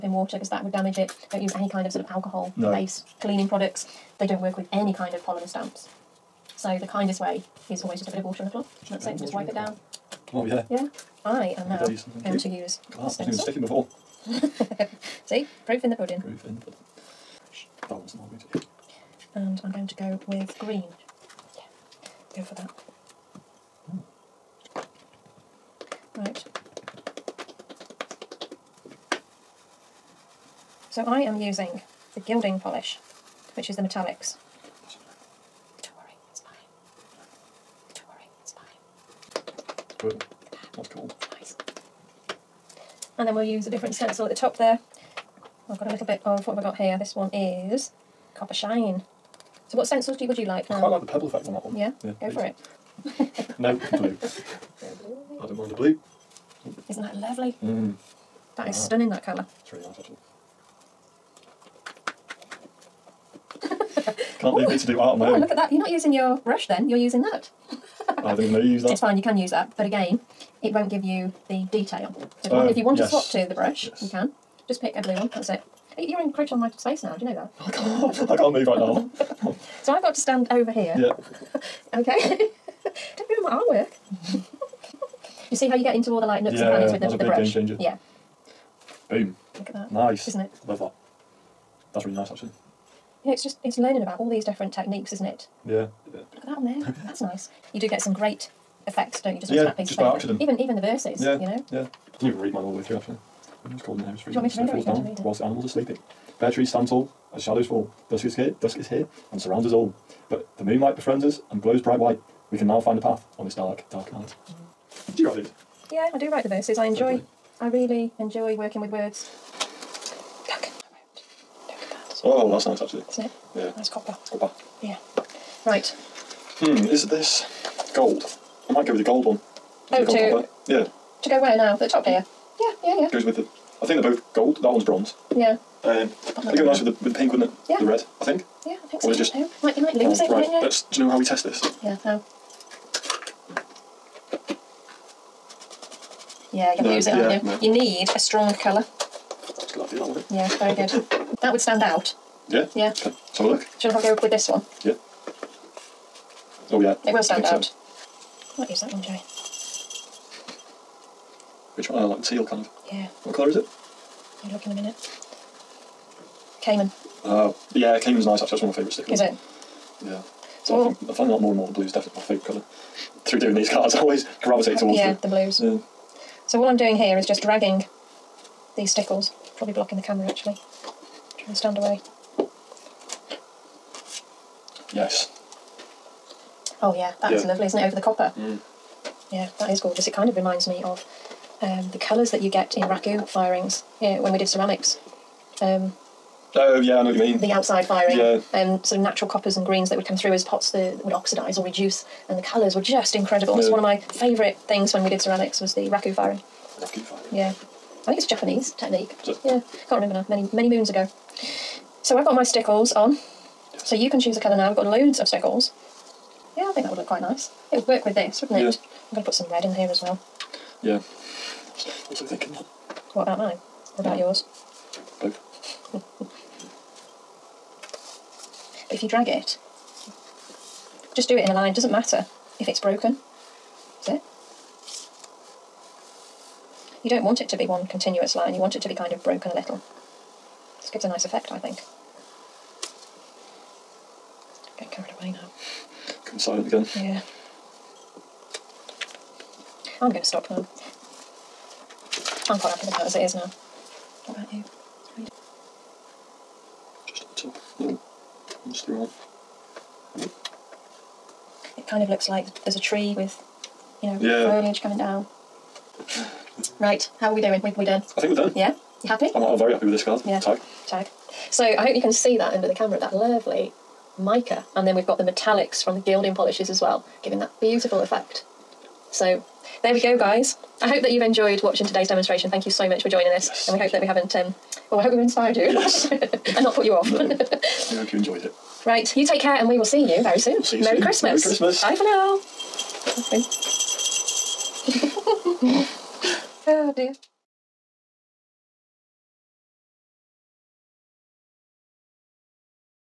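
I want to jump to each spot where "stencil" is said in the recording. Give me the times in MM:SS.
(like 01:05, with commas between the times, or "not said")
00:13, 00:43, 00:49.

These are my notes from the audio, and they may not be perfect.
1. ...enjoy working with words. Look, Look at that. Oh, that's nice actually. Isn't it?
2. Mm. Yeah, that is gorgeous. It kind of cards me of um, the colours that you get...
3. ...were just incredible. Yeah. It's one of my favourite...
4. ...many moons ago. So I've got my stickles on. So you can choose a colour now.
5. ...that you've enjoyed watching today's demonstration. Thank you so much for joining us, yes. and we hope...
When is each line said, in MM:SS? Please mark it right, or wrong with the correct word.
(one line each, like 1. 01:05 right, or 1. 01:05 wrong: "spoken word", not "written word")
1. 01:58 right
2. 03:08 wrong: "reminds", not "cards"
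3. 03:22 right
4. 03:30 right
5. 04:41 right.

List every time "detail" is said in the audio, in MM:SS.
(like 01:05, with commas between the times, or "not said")
01:11.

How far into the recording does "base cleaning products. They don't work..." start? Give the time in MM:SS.
00:02.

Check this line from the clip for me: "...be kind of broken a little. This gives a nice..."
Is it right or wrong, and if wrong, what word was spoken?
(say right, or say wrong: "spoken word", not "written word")
right.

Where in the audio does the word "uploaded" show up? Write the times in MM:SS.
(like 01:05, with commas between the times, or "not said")
not said.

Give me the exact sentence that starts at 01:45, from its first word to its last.
Whilst the animals are sleeping, bare trees stand tall as shadows fall.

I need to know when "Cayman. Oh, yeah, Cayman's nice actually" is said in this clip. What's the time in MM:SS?
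02:46.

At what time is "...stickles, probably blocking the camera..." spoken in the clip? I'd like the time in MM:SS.
02:58.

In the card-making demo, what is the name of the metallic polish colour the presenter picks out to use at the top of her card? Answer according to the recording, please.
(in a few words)
Copper Shine.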